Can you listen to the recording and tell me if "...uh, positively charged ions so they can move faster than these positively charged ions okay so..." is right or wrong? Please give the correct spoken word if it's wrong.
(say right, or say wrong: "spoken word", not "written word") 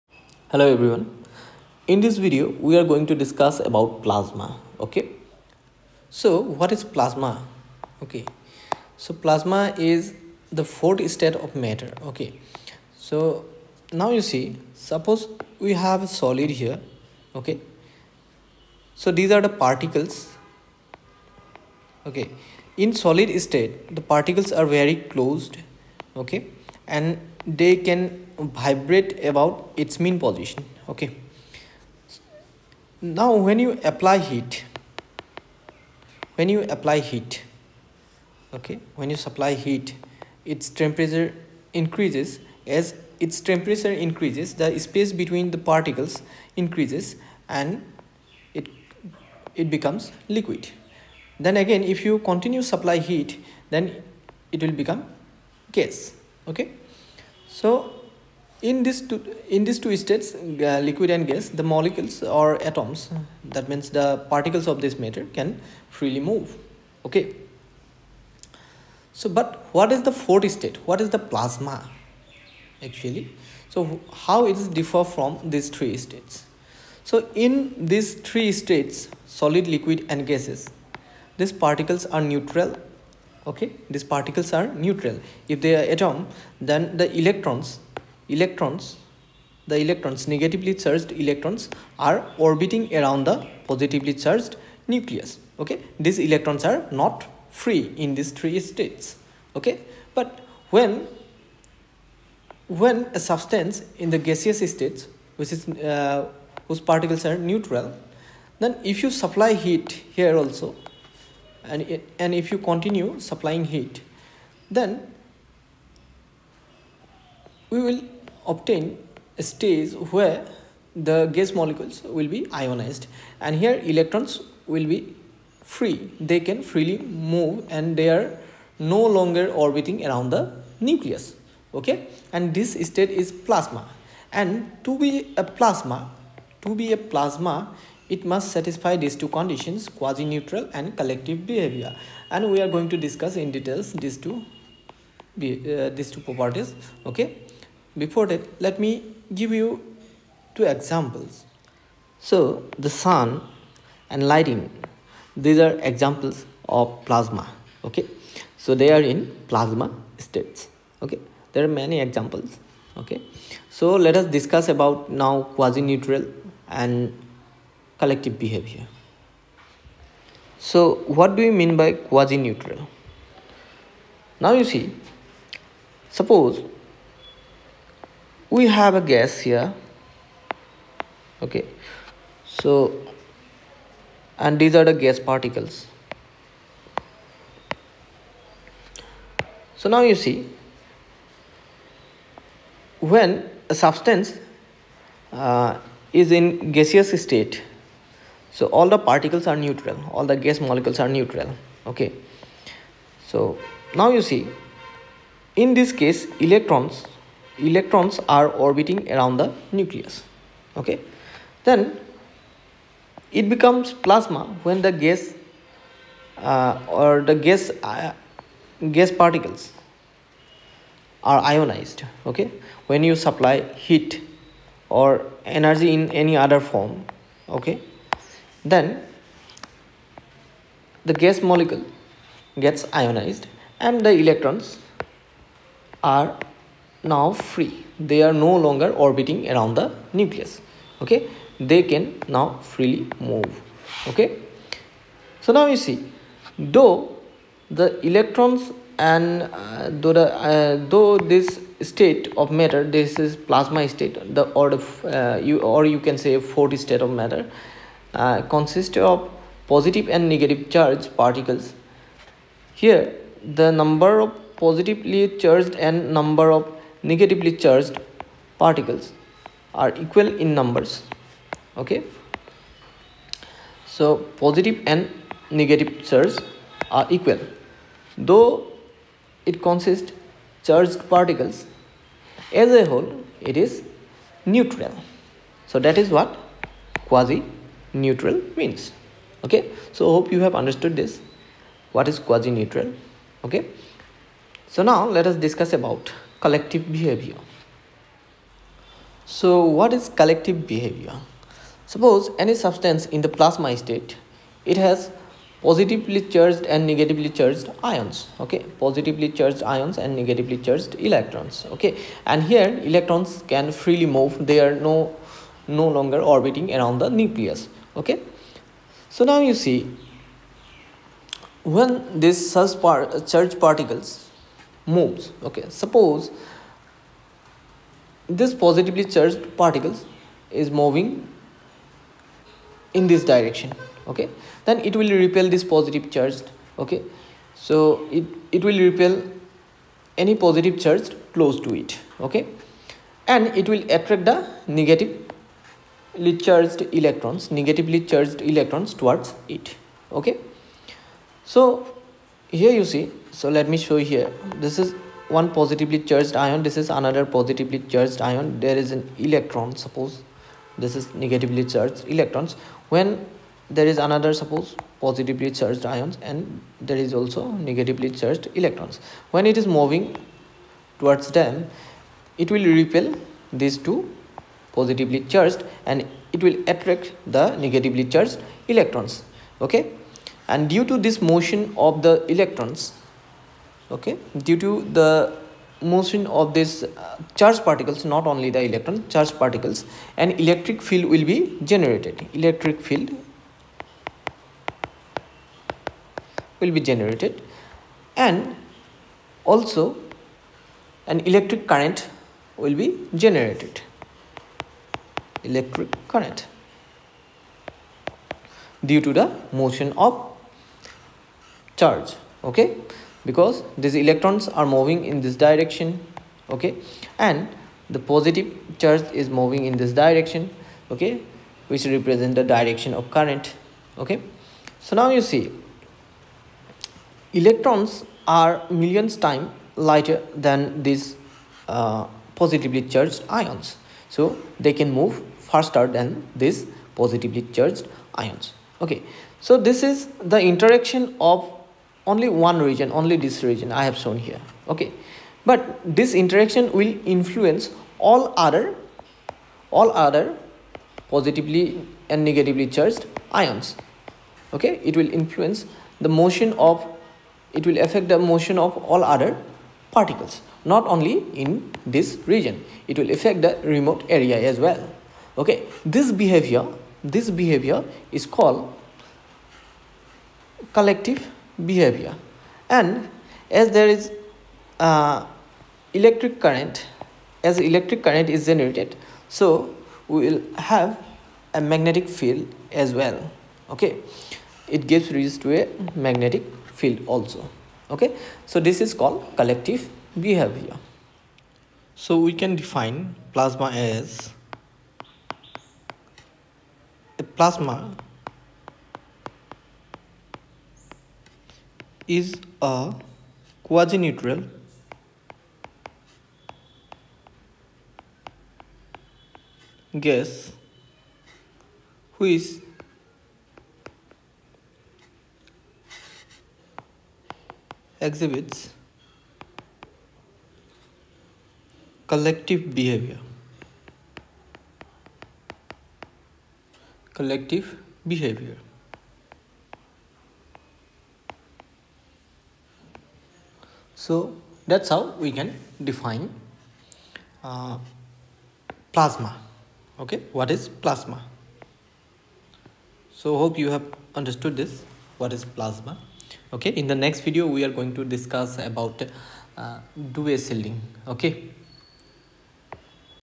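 right.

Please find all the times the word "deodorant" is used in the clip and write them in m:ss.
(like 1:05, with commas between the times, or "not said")
not said.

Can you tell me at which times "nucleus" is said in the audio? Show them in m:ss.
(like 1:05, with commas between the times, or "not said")
1:34, 2:10, 3:29, 4:00, 5:17.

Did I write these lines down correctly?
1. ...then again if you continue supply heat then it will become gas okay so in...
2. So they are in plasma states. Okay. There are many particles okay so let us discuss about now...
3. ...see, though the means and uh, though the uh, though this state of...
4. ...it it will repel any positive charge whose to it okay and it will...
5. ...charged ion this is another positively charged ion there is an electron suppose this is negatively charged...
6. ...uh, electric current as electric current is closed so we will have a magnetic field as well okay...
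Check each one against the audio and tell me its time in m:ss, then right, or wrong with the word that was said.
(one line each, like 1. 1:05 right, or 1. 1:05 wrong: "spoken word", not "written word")
1. 0:51 right
2. 2:38 wrong: "examples", not "particles"
3. 4:05 wrong: "electrons", not "means"
4. 5:38 wrong: "close", not "whose"
5. 5:55 right
6. 7:54 wrong: "generated", not "closed".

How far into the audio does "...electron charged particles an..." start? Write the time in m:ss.
6:28.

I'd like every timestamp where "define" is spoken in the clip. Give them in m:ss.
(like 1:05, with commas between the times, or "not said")
8:12, 8:55.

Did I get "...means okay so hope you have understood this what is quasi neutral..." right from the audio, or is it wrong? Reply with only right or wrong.
right.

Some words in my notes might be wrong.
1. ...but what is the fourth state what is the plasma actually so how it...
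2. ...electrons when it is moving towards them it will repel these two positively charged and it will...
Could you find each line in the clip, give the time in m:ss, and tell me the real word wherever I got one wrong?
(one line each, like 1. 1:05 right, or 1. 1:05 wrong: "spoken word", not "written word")
1. 1:09 right
2. 6:08 right.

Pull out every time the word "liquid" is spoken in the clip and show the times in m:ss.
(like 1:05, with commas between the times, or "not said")
0:50, 1:00, 1:19.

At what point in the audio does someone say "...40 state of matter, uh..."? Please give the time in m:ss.
4:16.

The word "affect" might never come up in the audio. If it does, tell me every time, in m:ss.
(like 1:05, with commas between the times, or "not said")
7:37, 7:43.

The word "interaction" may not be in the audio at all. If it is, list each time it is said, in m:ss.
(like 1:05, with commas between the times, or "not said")
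7:20, 7:26.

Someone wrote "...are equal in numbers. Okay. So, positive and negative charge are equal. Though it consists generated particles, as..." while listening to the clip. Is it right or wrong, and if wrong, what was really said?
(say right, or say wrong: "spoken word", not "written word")
wrong: "charged", not "generated".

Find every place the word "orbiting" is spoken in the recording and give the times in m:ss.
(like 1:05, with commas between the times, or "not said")
1:32, 2:09, 3:28, 3:58, 5:16.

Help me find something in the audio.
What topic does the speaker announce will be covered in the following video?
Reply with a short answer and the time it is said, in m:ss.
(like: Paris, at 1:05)
Selling, at 9:10.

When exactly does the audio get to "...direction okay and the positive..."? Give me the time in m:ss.
6:55.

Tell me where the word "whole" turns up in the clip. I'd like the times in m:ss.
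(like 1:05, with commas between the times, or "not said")
4:42.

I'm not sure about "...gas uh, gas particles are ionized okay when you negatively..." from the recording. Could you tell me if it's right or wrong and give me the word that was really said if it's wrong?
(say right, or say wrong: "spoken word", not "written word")
wrong: "supply", not "negatively".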